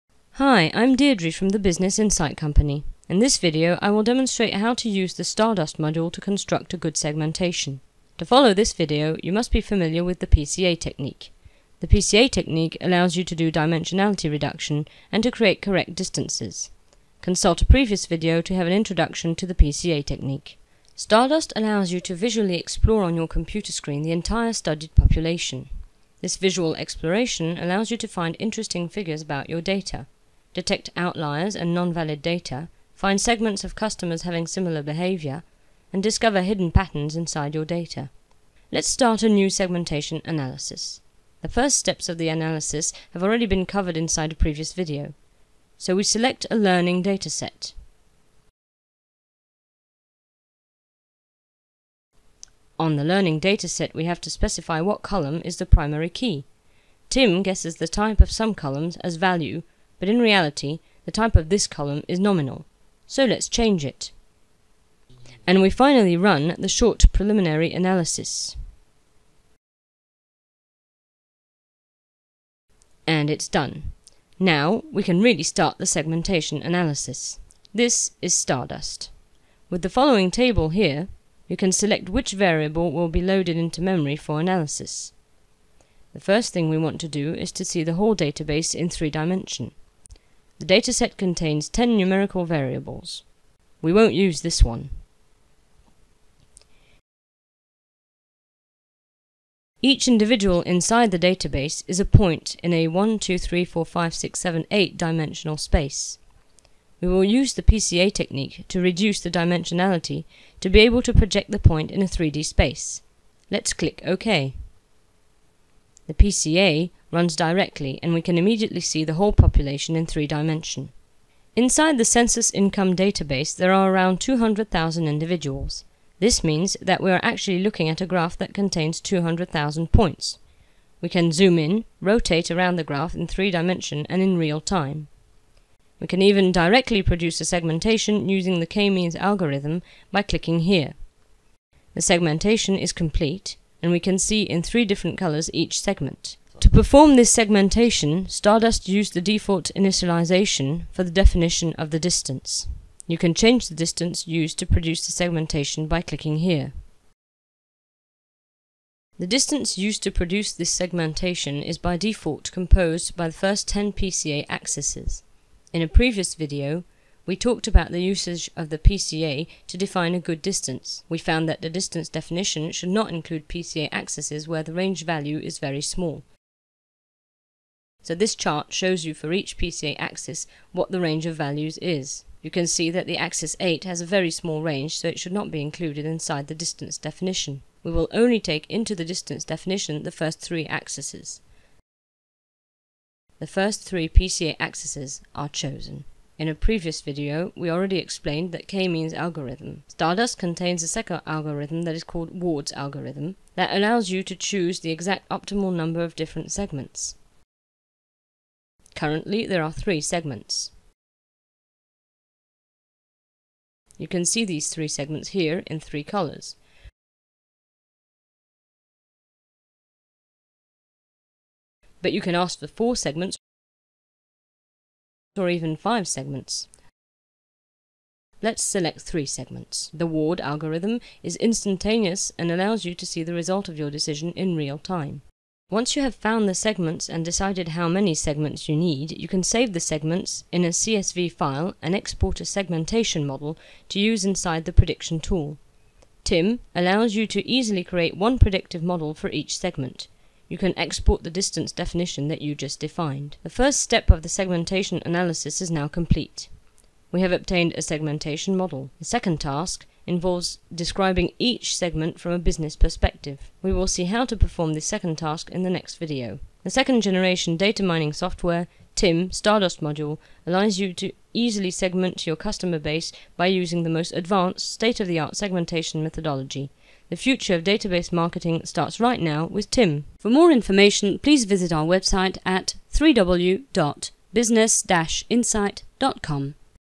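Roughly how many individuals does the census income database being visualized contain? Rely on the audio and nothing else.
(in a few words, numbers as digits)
200,000.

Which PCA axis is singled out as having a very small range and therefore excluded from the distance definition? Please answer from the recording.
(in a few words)
Axis 8.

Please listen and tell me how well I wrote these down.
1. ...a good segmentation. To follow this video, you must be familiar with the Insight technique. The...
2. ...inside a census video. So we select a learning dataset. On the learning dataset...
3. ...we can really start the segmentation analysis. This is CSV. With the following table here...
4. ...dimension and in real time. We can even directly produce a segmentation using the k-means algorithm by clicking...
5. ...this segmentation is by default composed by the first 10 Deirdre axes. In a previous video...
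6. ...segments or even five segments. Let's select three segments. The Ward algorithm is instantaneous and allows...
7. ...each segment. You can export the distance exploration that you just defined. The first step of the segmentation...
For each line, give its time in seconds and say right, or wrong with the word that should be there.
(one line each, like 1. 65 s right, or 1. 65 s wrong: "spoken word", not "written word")
1. 6 s wrong: "PCA", not "Insight"
2. 43 s wrong: "previous", not "census"
3. 74 s wrong: "Stardust", not "CSV"
4. 133 s right
5. 160 s wrong: "PCA", not "Deirdre"
6. 222 s right
7. 249 s wrong: "definition", not "exploration".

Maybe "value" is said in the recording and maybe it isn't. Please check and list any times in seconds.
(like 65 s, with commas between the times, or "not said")
59 s, 175 s, 181 s.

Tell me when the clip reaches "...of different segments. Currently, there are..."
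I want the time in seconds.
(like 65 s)
206 s.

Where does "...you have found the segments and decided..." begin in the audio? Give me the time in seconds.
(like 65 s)
235 s.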